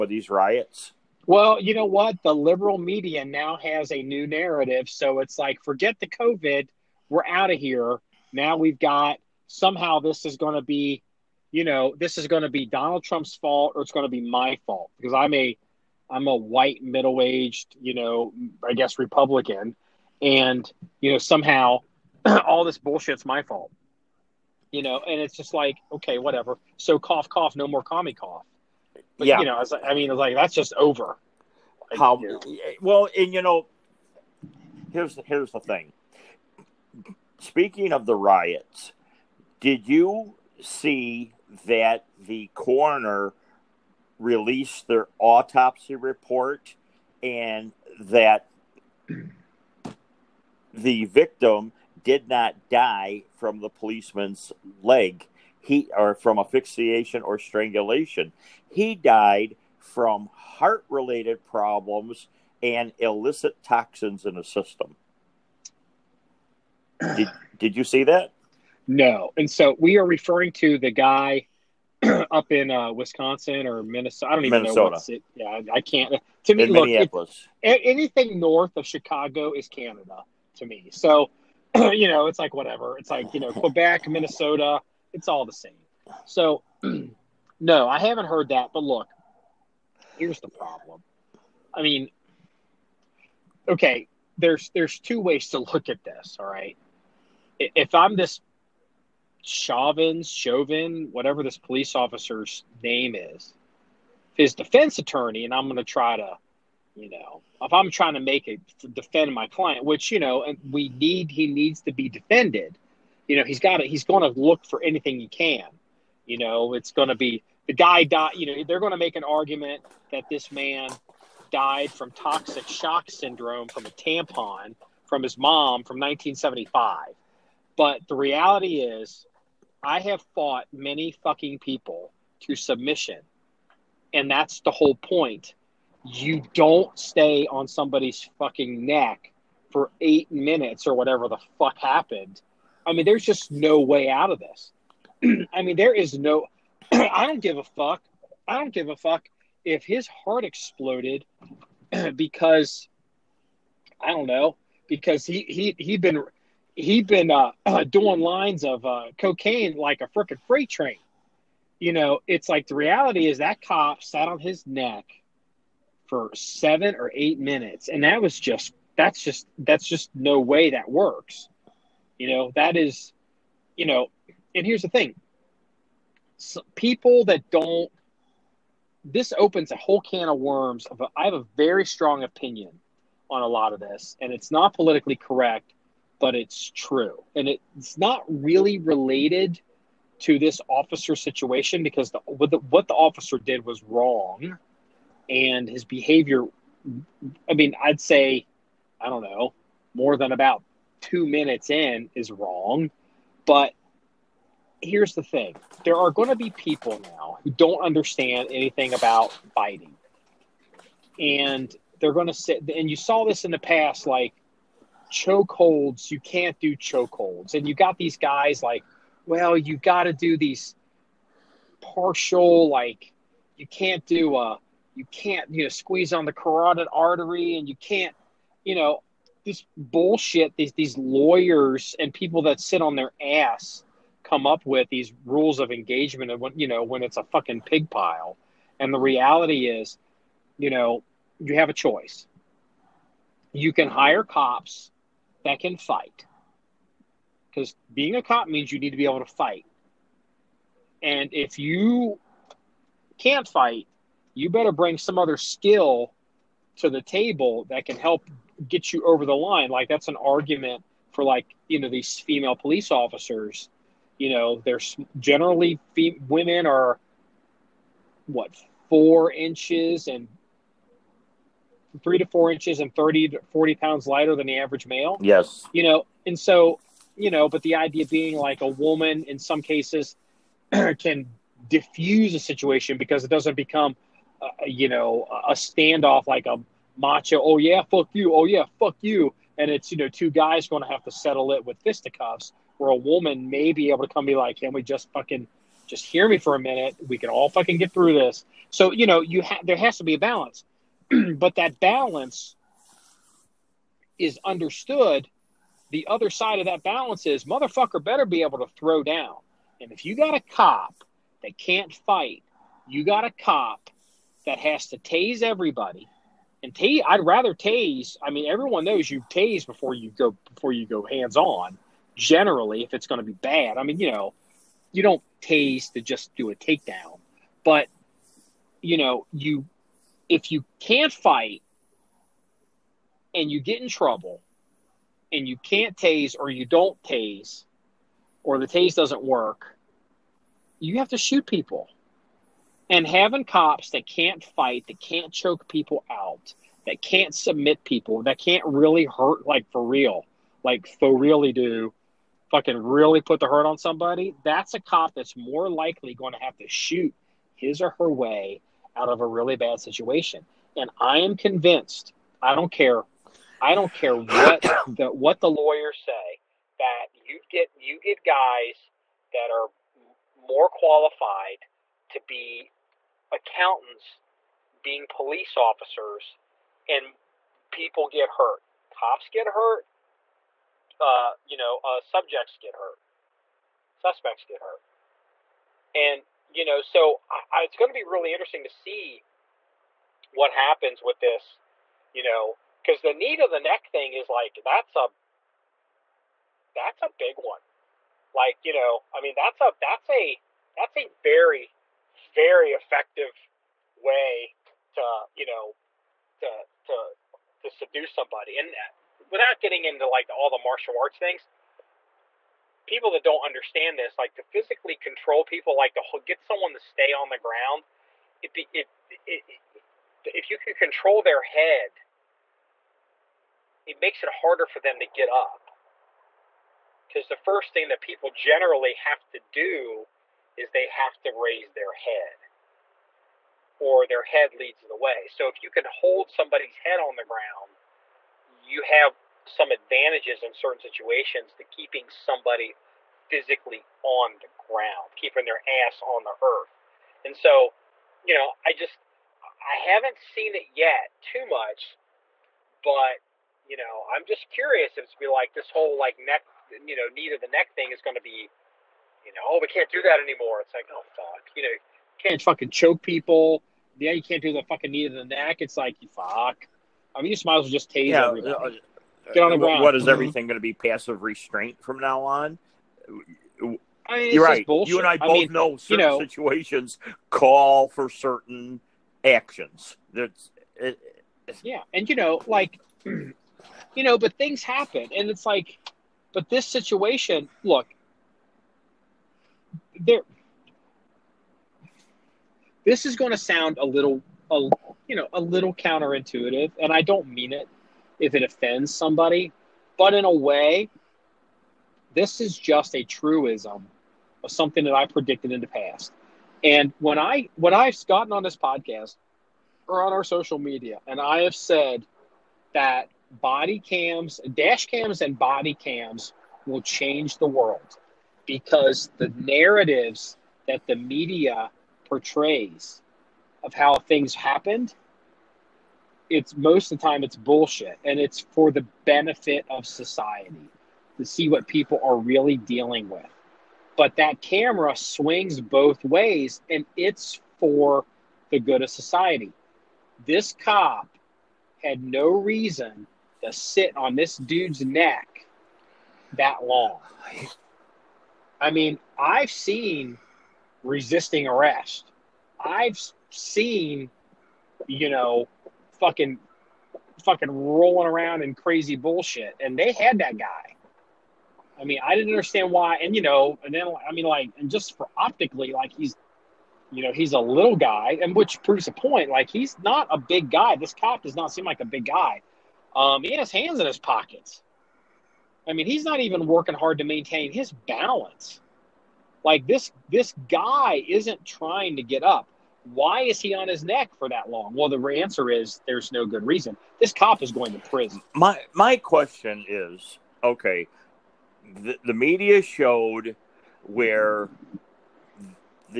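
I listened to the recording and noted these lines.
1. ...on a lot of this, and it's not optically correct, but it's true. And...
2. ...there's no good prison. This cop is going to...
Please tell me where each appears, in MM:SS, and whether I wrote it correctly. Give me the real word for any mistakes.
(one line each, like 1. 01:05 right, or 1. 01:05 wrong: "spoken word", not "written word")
1. 03:03 wrong: "politically", not "optically"
2. 09:45 wrong: "reason", not "prison".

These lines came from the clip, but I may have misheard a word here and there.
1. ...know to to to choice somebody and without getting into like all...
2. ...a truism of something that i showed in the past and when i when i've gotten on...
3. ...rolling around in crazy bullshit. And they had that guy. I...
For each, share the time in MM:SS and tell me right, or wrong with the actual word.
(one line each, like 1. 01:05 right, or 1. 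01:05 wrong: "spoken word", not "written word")
1. 06:45 wrong: "seduce", not "choice"
2. 08:22 wrong: "predicted", not "showed"
3. 09:17 right.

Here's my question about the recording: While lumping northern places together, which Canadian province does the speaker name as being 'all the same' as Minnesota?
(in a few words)
Quebec.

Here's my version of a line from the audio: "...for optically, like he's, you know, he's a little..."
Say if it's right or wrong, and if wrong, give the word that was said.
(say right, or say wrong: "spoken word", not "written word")
right.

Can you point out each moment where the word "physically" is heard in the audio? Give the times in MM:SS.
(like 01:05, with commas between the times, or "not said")
06:54, 07:23.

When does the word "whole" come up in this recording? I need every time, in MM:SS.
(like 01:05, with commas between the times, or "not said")
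02:14, 02:59, 07:35.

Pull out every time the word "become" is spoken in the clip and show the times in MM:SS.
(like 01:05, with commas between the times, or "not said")
04:43.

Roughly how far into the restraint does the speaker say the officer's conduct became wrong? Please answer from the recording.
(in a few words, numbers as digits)
about 2 minutes.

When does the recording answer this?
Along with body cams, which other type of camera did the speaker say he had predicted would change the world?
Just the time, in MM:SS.
08:34.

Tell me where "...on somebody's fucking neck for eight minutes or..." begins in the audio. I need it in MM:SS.
02:17.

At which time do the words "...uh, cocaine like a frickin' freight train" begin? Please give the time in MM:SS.
02:38.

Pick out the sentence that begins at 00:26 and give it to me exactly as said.
So cough, cough, no more commie cough but, yeah.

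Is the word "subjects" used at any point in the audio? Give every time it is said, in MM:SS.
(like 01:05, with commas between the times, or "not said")
06:21.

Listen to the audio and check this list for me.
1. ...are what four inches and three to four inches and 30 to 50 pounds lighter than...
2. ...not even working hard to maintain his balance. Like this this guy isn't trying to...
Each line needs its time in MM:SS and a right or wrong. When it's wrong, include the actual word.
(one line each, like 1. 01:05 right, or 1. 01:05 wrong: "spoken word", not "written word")
1. 04:26 wrong: "40", not "50"
2. 09:36 right.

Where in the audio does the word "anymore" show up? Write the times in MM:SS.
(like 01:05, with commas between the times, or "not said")
07:40.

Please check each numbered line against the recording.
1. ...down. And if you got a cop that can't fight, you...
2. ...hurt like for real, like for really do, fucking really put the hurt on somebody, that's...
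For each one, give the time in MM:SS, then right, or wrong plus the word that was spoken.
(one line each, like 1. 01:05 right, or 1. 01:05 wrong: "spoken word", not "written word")
1. 05:09 right
2. 05:49 right.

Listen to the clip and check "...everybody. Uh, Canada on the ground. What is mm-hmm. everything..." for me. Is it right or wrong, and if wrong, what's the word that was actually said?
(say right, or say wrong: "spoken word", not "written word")
wrong: "Get", not "Canada".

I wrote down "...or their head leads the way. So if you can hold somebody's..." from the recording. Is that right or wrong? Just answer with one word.
right.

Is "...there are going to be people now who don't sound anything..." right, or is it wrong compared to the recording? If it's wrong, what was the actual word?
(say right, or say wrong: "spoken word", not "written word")
wrong: "understand", not "sound".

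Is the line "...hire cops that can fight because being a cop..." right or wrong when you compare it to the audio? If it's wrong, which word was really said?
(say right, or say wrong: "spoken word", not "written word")
right.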